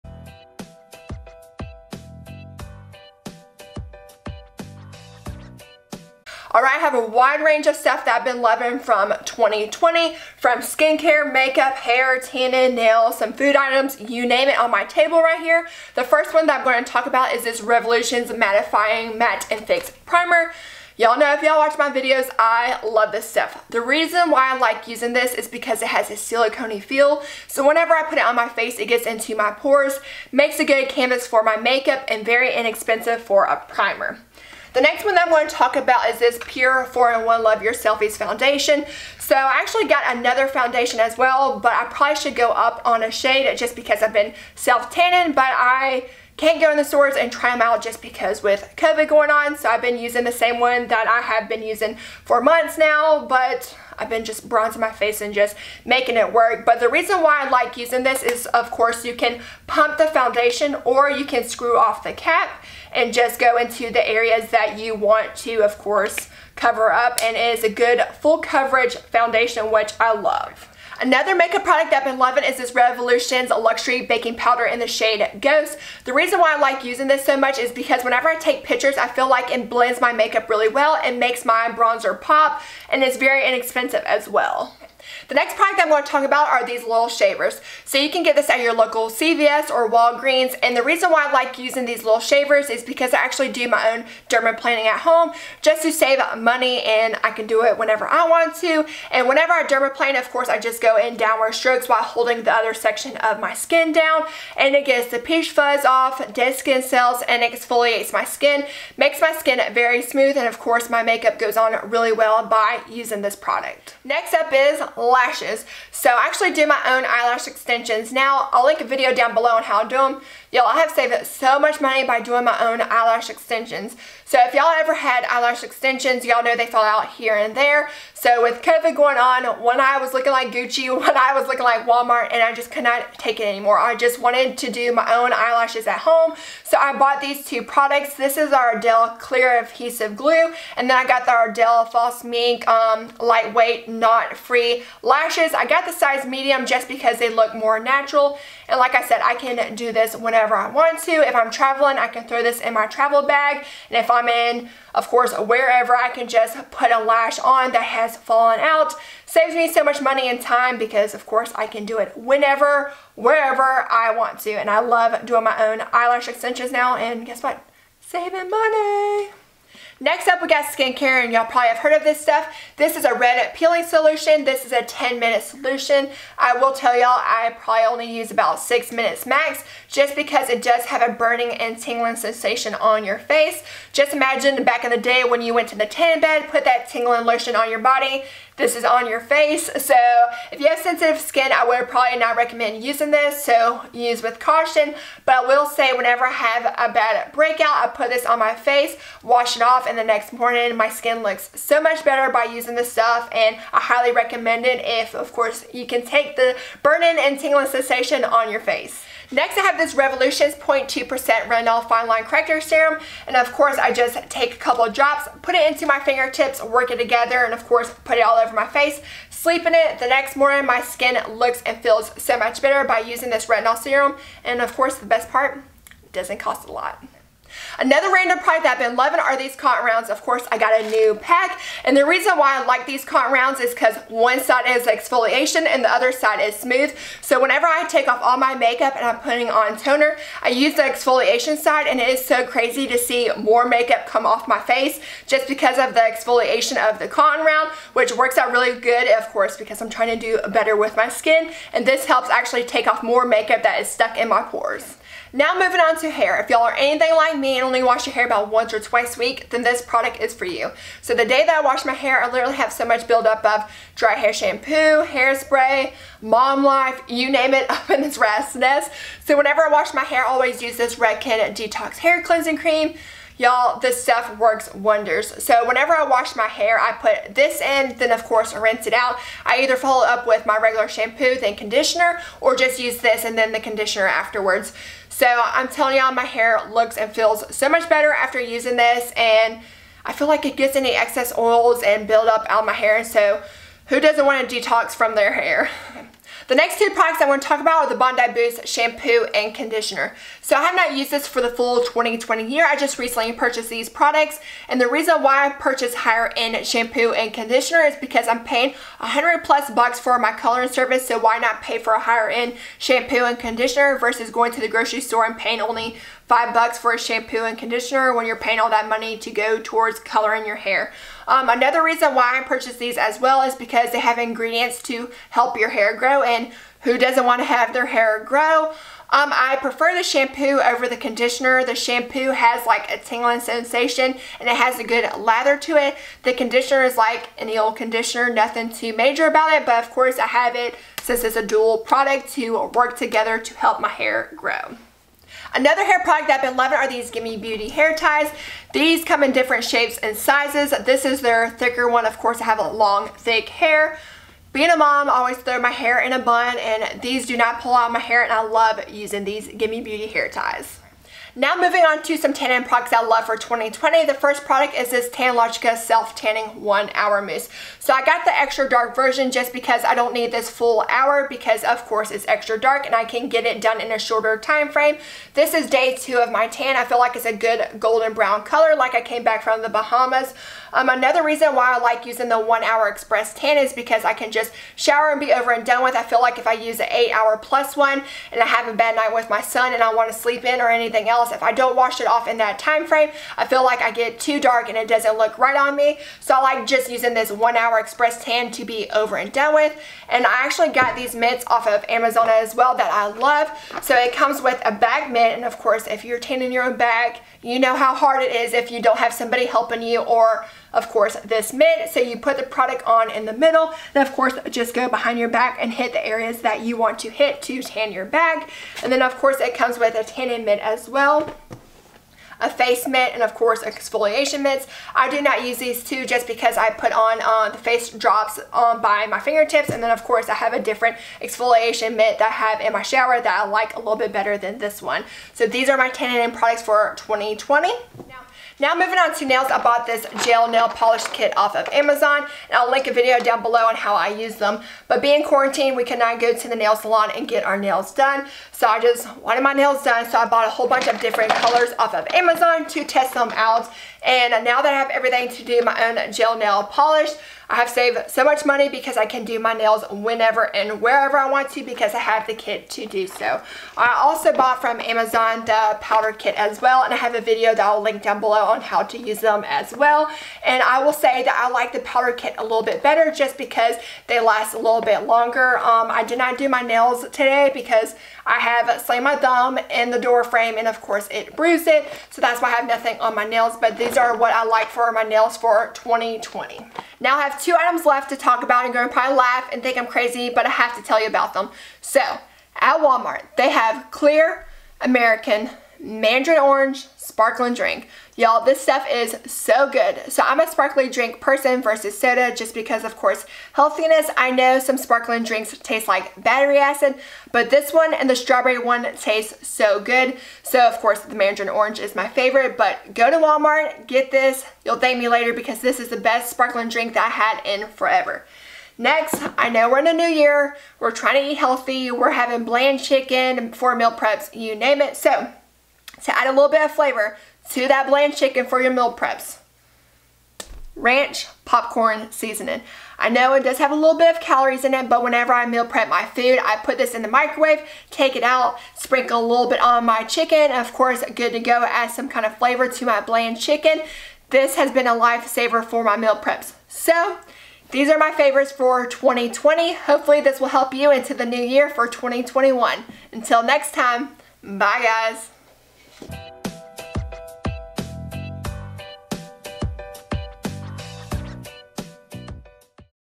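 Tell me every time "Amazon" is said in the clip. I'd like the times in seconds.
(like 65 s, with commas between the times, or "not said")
401 s, 441 s, 452 s, 464 s.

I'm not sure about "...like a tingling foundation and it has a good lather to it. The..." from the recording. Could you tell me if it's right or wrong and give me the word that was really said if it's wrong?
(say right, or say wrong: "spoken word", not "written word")
wrong: "sensation", not "foundation".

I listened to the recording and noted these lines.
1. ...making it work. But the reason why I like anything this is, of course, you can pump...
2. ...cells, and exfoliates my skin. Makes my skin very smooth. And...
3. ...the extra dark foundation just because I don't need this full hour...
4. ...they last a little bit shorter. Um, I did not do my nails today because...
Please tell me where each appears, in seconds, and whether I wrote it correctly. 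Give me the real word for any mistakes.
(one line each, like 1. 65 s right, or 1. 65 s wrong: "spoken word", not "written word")
1. 55 s wrong: "using", not "anything"
2. 106 s right
3. 368 s wrong: "version", not "foundation"
4. 474 s wrong: "longer", not "shorter".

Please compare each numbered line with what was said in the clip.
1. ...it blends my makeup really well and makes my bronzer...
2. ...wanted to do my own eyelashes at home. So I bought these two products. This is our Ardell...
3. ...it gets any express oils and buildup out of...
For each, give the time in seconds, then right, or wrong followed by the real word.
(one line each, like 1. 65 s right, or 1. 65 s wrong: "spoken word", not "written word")
1. 79 s right
2. 134 s right
3. 290 s wrong: "excess", not "express".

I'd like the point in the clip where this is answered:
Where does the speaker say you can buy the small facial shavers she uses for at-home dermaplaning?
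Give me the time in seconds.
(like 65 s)
89 s.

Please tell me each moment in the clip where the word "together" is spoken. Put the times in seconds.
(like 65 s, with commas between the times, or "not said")
216 s, 342 s.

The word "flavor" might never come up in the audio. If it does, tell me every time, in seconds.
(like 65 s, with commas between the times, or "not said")
526 s, 542 s.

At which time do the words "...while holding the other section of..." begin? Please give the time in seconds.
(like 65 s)
101 s.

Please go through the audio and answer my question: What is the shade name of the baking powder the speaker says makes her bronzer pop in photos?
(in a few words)
Ghost.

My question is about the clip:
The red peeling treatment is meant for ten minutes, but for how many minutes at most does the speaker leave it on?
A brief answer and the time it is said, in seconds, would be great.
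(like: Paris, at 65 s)
6, at 178 s.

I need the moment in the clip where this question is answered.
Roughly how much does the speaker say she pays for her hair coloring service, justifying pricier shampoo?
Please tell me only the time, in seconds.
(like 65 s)
308 s.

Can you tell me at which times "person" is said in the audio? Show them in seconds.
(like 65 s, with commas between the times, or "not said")
501 s.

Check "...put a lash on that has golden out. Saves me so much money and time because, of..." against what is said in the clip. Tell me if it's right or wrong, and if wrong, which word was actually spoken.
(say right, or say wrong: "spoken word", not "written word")
wrong: "fallen", not "golden".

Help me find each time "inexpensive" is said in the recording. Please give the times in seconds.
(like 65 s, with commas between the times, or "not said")
32 s, 83 s.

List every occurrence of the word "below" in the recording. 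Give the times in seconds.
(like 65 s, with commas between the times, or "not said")
119 s, 443 s, 468 s.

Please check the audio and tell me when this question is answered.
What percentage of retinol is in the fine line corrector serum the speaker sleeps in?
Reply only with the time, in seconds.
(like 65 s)
210 s.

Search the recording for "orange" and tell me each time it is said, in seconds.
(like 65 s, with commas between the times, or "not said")
496 s, 511 s.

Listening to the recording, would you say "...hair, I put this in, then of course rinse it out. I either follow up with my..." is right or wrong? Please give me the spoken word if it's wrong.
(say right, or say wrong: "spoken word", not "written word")
right.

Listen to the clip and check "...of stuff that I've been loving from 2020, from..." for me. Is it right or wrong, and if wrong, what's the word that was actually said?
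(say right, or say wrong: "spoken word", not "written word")
right.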